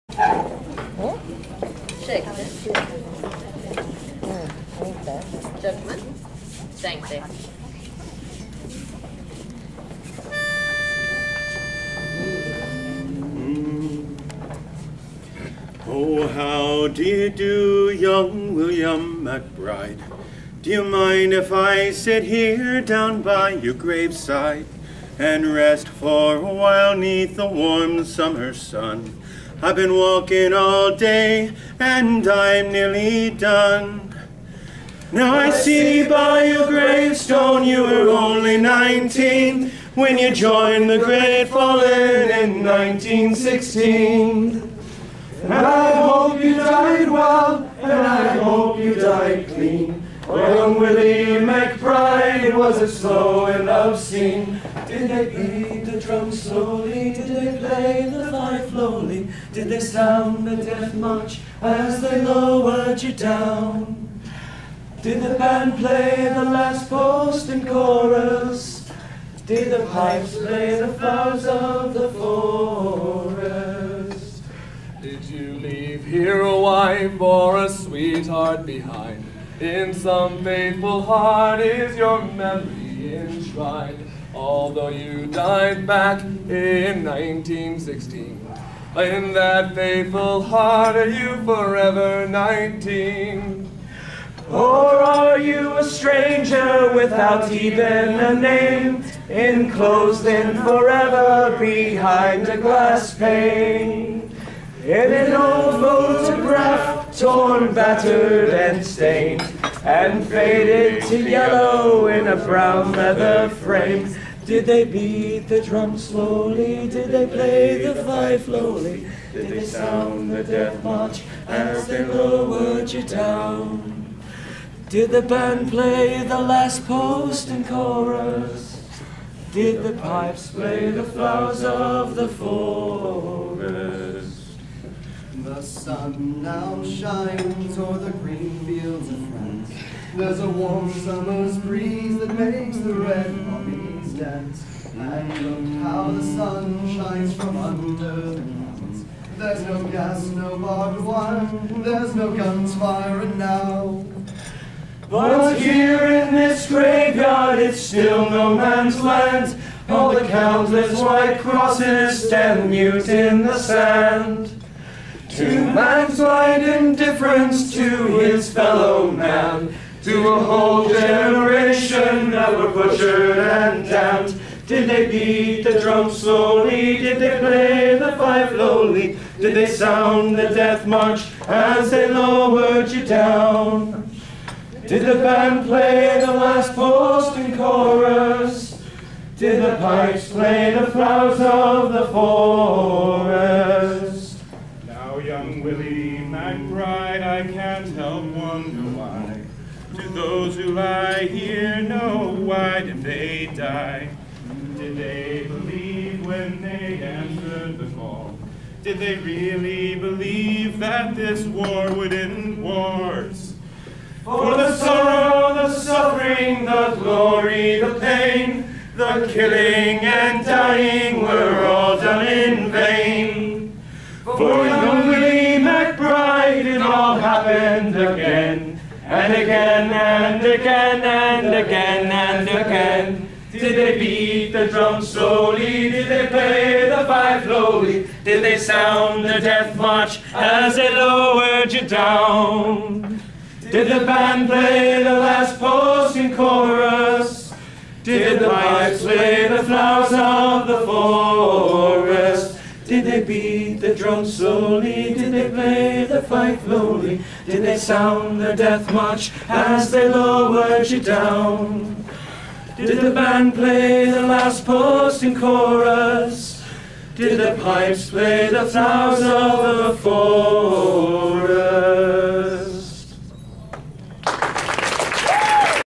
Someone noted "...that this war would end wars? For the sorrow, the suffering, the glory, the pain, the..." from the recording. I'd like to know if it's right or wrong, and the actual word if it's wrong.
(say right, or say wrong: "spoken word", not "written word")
right.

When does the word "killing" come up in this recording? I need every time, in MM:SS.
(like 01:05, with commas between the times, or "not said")
03:39.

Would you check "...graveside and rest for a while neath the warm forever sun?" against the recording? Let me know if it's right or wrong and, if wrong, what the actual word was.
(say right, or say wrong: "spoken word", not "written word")
wrong: "summer", not "forever".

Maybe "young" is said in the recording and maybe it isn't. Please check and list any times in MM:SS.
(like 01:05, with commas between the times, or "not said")
00:17, 03:15, 03:44.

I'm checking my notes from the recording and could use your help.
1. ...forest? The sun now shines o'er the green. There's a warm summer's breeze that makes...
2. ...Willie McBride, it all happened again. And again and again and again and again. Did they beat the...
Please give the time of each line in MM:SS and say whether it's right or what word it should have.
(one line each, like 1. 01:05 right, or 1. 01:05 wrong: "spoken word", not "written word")
1. 02:12 right
2. 03:45 right.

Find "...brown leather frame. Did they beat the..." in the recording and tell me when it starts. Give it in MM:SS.
01:52.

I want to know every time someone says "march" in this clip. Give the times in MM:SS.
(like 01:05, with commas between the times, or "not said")
01:00, 02:00, 03:00, 03:59, 04:18.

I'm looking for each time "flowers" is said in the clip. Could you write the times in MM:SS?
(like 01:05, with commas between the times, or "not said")
01:10, 02:11, 03:10, 04:09, 04:28.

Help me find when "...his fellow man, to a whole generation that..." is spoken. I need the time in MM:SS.
02:48.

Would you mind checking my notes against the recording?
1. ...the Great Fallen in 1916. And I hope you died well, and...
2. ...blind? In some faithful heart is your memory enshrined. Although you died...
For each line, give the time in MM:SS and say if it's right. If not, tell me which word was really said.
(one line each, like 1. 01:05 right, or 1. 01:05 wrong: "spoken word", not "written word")
1. 00:40 right
2. 01:18 wrong: "behind", not "blind".